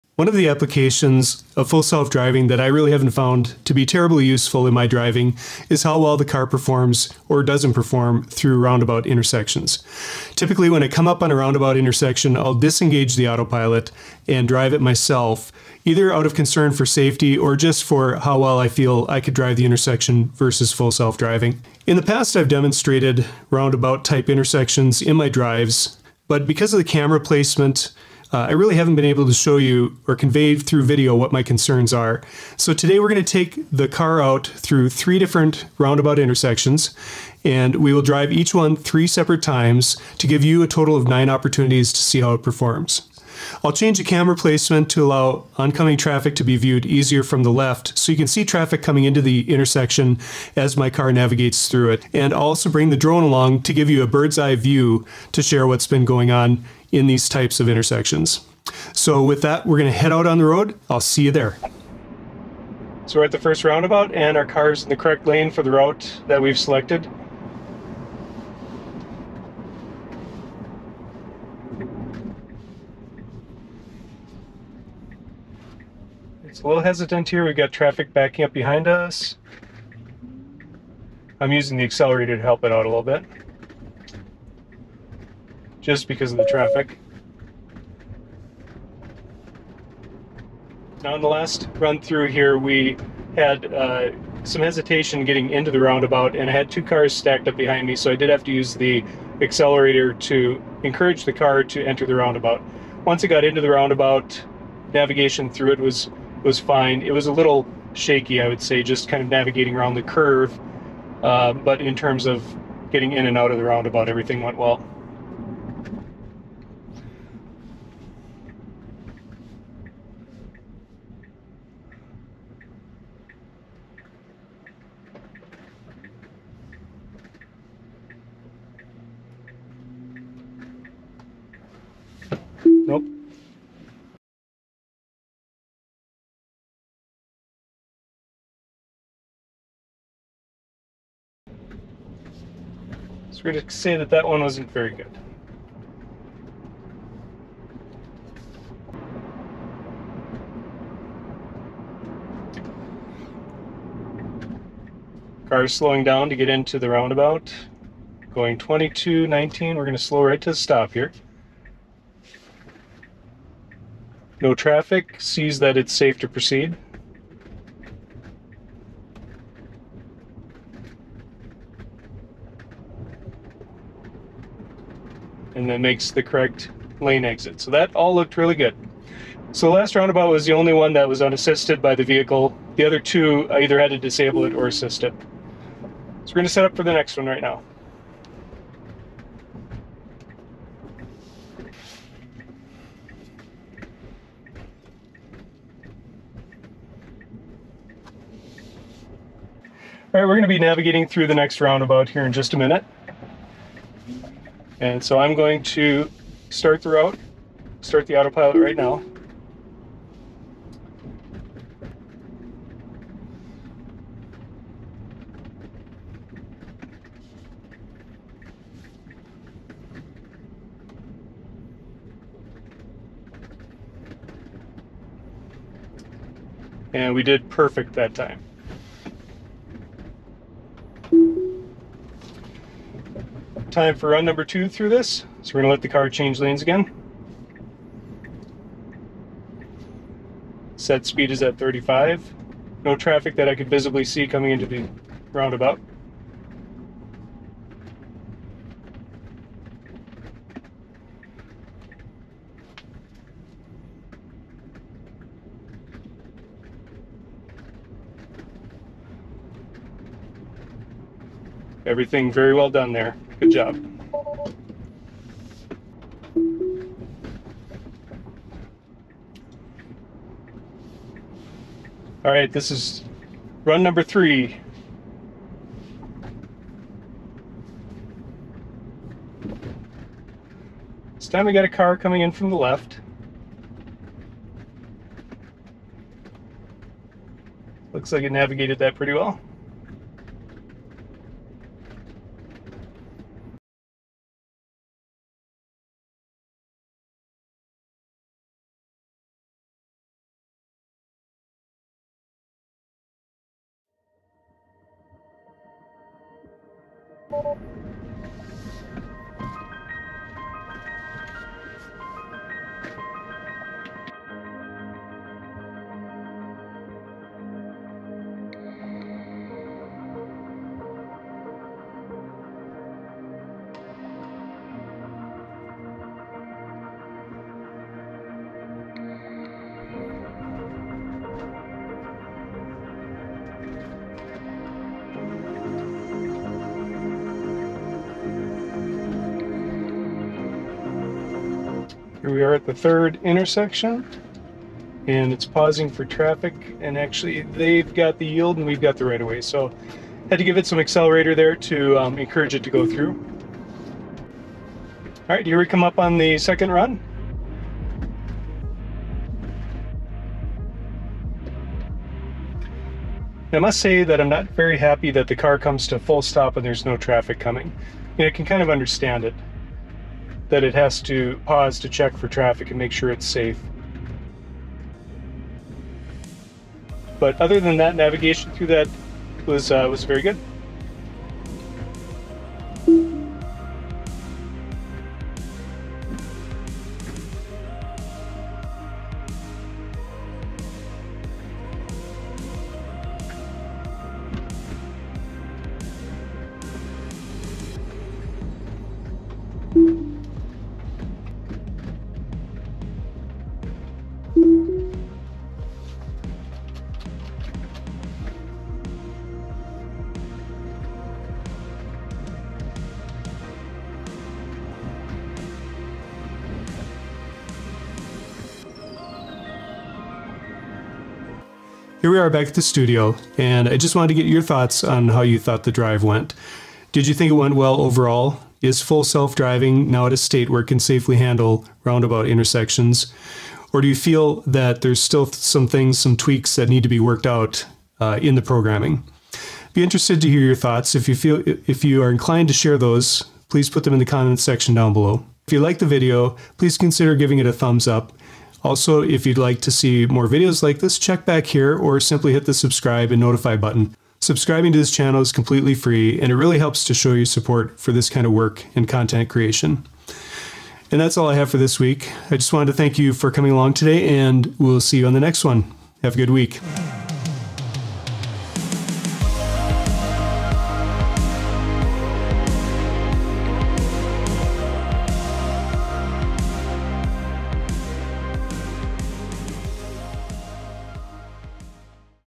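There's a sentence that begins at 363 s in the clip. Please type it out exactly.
I must say that I'm not very happy that the car comes to full stop and there's no traffic coming.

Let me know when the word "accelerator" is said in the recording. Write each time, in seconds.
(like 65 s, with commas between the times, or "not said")
81 s, 99 s, 350 s.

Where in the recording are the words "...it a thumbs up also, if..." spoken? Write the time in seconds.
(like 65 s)
447 s.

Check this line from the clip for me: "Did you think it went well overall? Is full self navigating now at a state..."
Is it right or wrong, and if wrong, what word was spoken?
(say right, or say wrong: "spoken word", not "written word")
wrong: "driving", not "navigating".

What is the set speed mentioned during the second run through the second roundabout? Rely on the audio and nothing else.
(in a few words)
35.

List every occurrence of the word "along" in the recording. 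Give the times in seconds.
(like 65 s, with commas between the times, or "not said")
53 s, 463 s.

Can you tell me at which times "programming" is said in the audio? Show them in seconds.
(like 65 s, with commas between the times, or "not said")
438 s.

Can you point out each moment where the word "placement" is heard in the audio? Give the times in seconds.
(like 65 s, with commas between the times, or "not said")
27 s, 44 s.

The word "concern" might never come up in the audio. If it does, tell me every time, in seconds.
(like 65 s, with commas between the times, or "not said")
16 s, 31 s.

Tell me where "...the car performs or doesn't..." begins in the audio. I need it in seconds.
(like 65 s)
6 s.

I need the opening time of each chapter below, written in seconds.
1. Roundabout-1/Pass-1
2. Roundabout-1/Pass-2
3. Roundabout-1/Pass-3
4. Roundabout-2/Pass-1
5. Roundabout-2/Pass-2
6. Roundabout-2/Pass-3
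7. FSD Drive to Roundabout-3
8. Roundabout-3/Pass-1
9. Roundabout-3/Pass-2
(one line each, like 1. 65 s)
1. 60 s
2. 112 s
3. 150 s
4. 209 s
5. 241 s
6. 275 s
7. 314 s
8. 331 s
9. 357 s.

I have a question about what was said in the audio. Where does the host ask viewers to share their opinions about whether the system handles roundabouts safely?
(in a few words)
comments section.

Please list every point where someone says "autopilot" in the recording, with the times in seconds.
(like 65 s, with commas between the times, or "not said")
13 s, 208 s.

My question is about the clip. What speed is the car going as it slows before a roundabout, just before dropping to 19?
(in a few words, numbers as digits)
22.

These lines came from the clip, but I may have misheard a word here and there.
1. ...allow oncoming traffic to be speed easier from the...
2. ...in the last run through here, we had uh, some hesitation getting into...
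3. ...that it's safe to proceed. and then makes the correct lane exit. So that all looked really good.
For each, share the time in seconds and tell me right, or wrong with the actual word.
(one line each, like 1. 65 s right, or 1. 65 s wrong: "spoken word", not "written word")
1. 45 s wrong: "viewed", not "speed"
2. 91 s right
3. 165 s right.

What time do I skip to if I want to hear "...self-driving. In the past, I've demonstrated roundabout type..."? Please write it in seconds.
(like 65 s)
20 s.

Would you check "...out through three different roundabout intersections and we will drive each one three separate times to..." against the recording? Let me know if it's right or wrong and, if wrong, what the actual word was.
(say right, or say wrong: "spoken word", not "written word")
right.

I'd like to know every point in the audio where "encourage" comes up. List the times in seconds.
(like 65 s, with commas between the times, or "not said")
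100 s, 352 s.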